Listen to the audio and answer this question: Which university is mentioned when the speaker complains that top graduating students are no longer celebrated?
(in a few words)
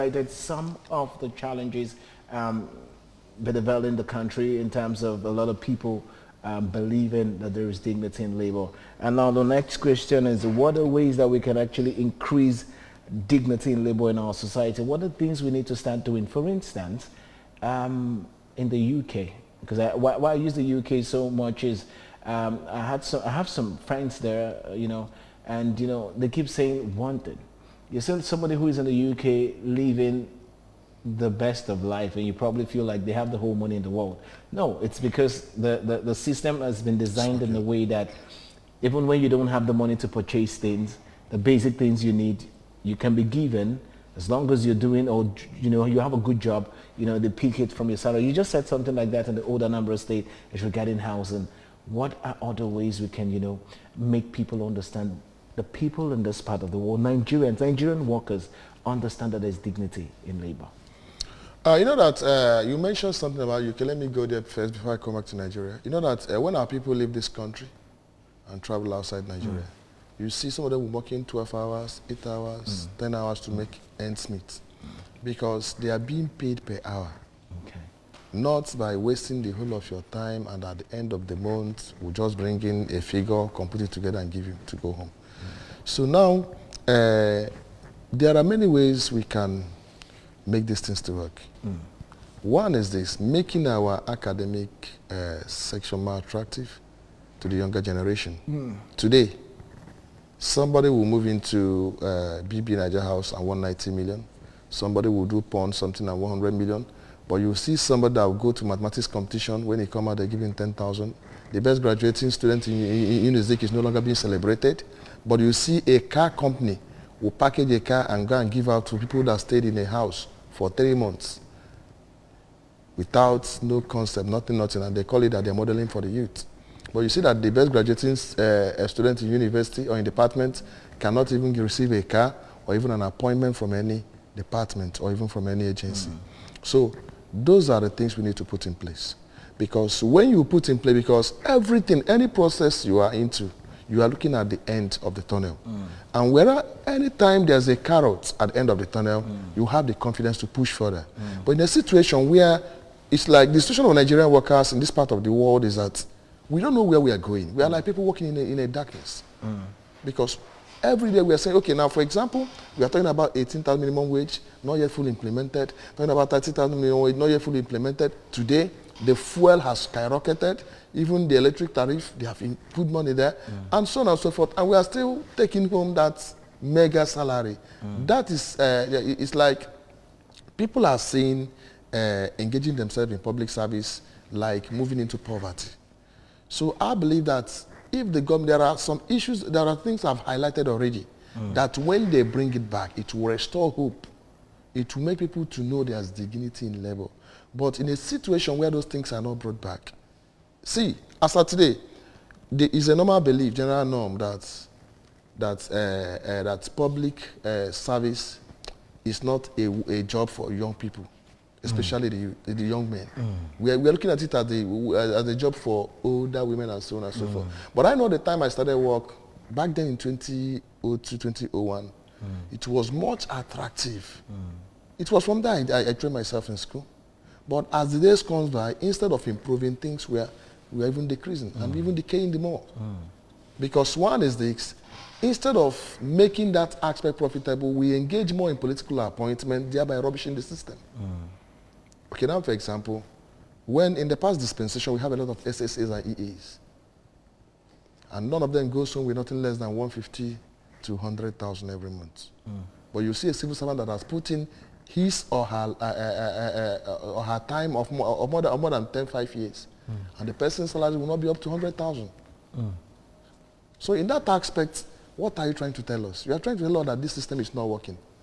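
Unizik.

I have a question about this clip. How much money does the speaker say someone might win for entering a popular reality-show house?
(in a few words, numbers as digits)
190 million.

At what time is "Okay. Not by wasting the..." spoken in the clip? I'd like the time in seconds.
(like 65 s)
77 s.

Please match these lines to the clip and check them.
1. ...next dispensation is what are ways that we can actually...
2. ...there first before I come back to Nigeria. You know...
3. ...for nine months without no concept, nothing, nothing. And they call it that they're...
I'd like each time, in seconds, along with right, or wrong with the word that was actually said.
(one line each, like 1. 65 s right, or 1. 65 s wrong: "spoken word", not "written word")
1. 9 s wrong: "question", not "dispensation"
2. 64 s right
3. 120 s wrong: "three", not "nine".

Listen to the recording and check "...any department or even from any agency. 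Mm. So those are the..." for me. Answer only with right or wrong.
right.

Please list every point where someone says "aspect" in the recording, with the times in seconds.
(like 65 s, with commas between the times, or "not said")
236 s, 264 s.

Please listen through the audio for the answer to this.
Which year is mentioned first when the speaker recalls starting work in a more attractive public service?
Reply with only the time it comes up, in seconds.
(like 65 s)
219 s.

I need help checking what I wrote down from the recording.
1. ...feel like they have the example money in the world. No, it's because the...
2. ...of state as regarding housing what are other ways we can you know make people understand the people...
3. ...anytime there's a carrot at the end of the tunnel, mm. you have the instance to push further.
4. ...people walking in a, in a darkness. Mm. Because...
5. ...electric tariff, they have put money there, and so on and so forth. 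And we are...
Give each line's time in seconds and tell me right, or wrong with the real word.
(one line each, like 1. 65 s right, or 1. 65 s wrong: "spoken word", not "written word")
1. 32 s wrong: "whole", not "example"
2. 49 s right
3. 146 s wrong: "confidence", not "instance"
4. 157 s right
5. 171 s right.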